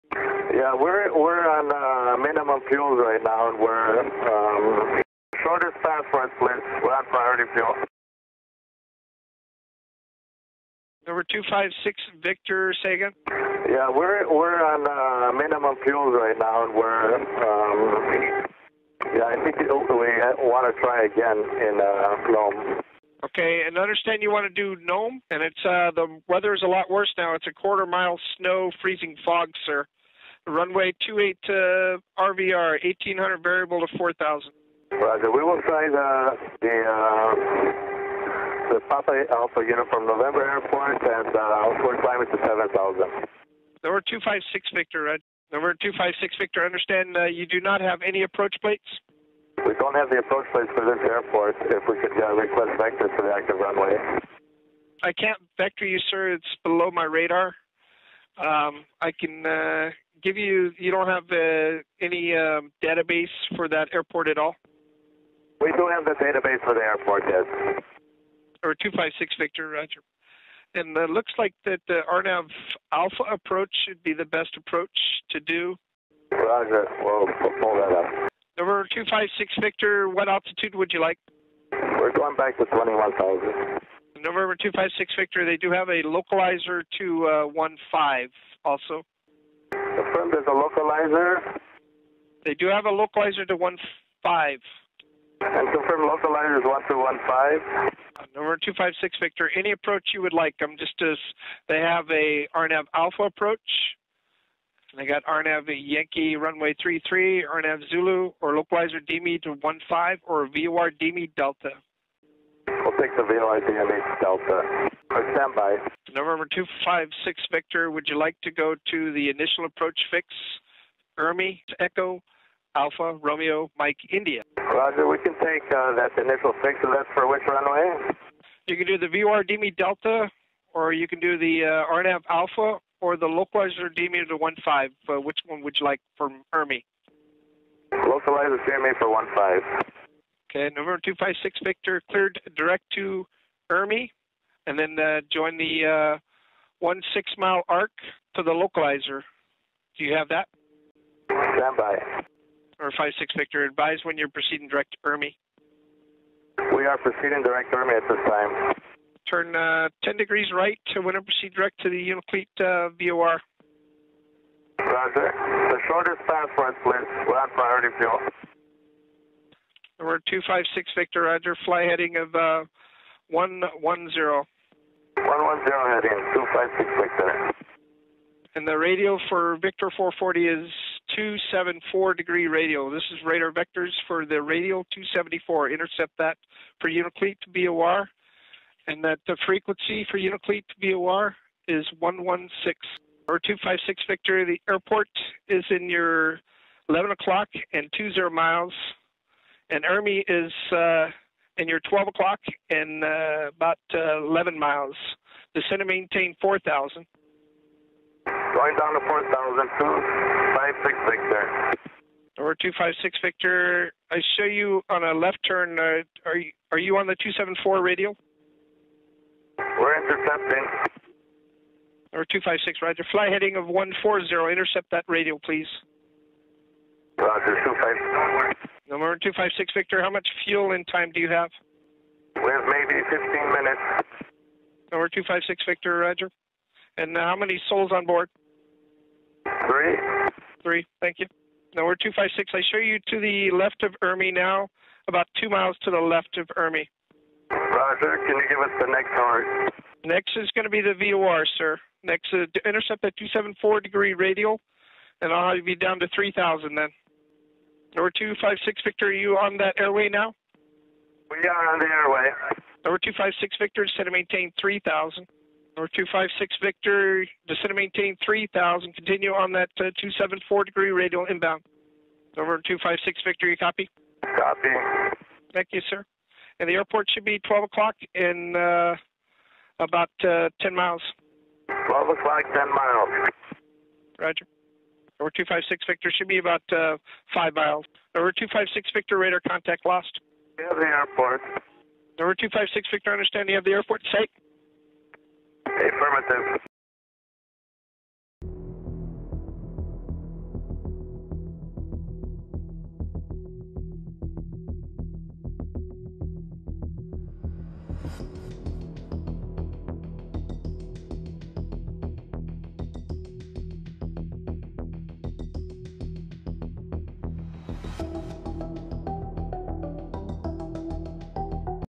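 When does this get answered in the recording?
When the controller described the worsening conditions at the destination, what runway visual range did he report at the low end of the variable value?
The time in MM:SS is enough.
00:32.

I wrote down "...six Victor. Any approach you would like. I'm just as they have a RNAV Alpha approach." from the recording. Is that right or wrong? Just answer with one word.
right.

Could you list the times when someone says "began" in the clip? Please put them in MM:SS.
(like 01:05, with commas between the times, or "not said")
not said.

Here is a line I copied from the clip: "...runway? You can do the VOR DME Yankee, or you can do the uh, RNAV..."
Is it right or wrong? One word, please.
wrong.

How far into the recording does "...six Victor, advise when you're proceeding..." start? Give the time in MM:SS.
02:33.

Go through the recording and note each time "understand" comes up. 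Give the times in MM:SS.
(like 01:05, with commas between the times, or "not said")
00:23, 00:46, 04:53.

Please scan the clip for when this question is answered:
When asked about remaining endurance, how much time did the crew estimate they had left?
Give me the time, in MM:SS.
03:53.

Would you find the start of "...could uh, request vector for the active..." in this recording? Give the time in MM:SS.
00:52.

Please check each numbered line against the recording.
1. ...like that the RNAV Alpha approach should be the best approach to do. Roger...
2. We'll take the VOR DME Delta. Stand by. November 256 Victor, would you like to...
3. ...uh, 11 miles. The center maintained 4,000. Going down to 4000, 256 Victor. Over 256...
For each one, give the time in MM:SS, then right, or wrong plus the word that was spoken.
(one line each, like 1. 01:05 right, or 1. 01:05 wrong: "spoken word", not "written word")
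1. 01:11 right
2. 01:52 right
3. 03:23 right.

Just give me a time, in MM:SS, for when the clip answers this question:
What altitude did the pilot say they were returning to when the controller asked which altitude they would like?
01:22.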